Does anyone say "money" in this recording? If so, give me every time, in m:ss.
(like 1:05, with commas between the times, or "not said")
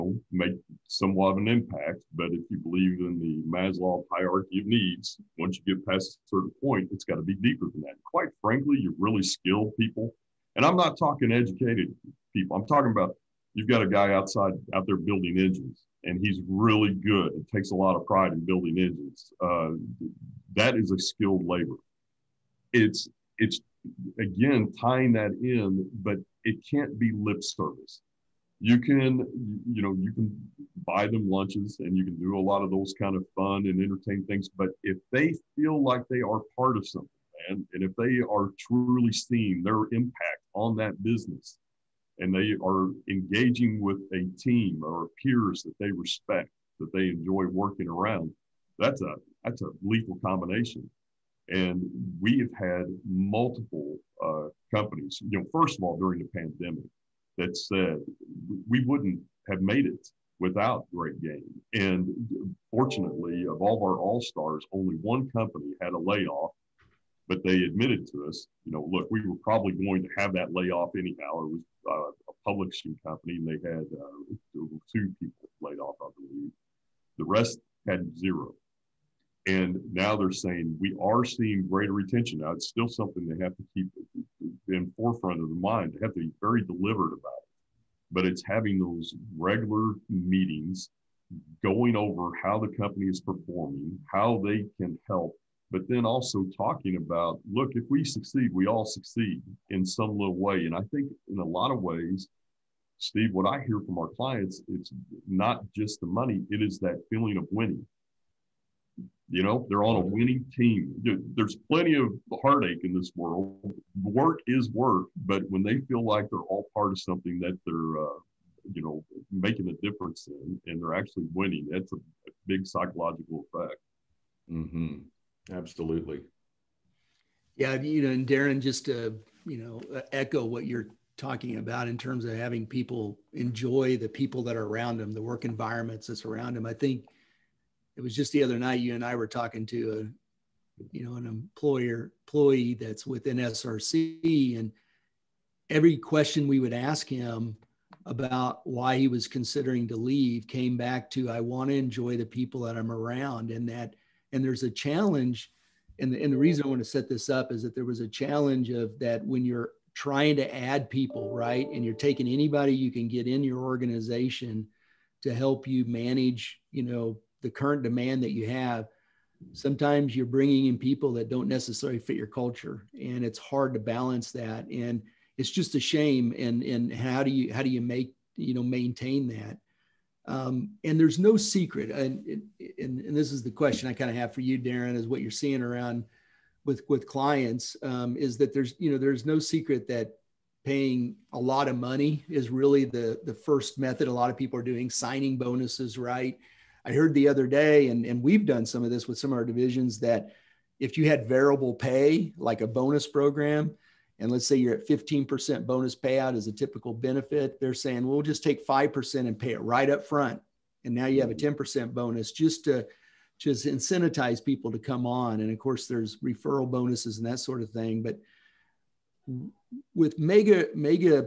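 1:46, 3:11.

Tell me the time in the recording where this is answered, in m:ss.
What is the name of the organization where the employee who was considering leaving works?
2:23.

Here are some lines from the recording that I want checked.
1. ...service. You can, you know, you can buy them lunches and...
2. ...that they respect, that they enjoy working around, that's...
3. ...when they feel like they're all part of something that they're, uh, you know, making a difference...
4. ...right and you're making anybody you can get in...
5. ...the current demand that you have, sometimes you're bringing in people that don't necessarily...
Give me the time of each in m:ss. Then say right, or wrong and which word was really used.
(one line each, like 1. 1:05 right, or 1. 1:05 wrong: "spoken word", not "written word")
1. 0:27 right
2. 0:45 right
3. 1:55 right
4. 2:41 wrong: "taking", not "making"
5. 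2:47 right.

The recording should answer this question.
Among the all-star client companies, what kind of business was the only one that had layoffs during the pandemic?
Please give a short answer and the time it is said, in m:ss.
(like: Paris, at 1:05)
Publishing company, at 1:12.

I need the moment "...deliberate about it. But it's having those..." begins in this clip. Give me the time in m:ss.
1:26.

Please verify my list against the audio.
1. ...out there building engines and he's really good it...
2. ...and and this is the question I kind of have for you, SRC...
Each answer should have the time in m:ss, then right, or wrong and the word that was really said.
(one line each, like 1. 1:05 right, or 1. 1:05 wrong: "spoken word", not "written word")
1. 0:14 right
2. 3:02 wrong: "Darin", not "SRC".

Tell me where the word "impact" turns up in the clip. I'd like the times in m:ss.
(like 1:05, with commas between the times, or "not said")
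0:01, 0:39.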